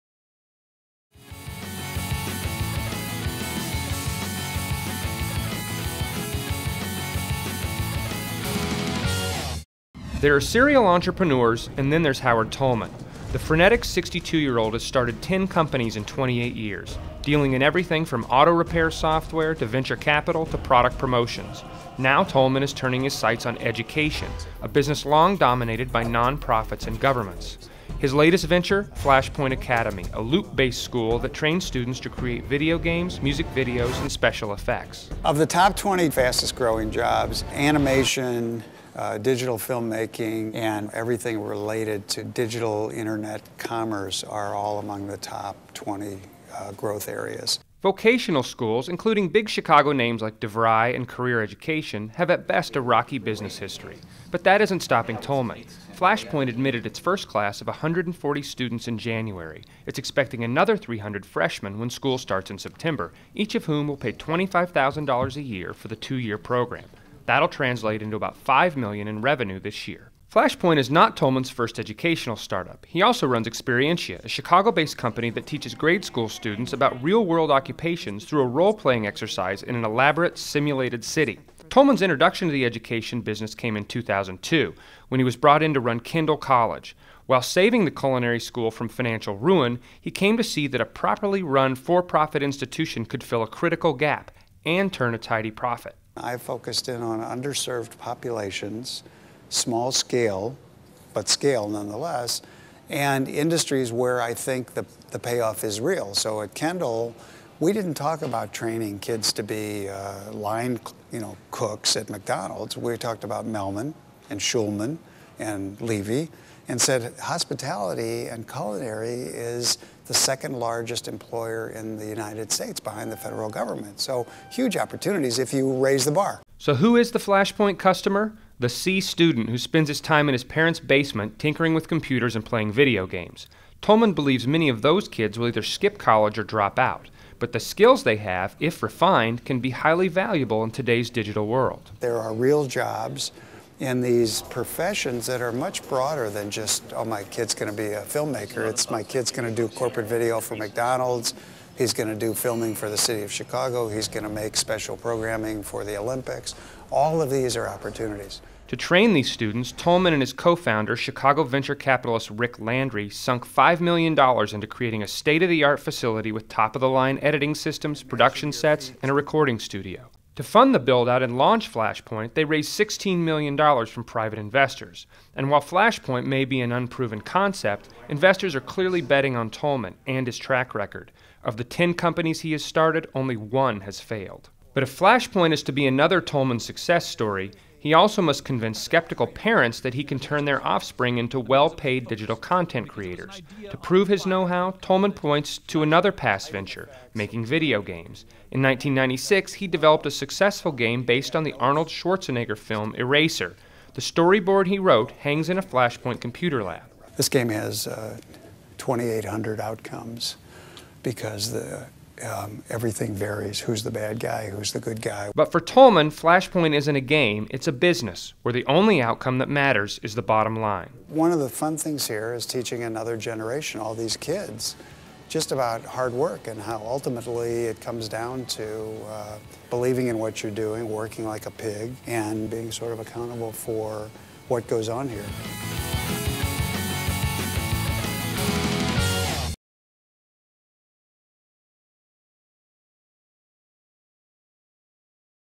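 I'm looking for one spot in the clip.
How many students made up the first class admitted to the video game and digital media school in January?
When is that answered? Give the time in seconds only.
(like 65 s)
57 s.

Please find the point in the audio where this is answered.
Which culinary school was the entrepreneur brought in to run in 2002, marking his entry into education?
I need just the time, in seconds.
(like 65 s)
85 s.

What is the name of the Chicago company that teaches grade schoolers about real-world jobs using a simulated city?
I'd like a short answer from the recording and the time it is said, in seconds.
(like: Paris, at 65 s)
Experientia, at 73 s.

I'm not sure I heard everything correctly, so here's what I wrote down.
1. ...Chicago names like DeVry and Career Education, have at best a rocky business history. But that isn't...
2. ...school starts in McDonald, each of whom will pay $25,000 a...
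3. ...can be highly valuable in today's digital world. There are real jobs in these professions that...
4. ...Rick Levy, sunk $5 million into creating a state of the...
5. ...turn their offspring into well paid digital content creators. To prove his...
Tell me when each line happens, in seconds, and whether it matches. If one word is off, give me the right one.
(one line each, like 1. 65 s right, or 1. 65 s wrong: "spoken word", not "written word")
1. 49 s right
2. 61 s wrong: "September", not "McDonald"
3. 139 s right
4. 162 s wrong: "Landry", not "Levy"
5. 190 s right.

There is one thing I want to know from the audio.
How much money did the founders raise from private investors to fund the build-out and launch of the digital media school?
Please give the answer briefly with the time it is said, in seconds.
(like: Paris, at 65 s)
$16 million, at 172 s.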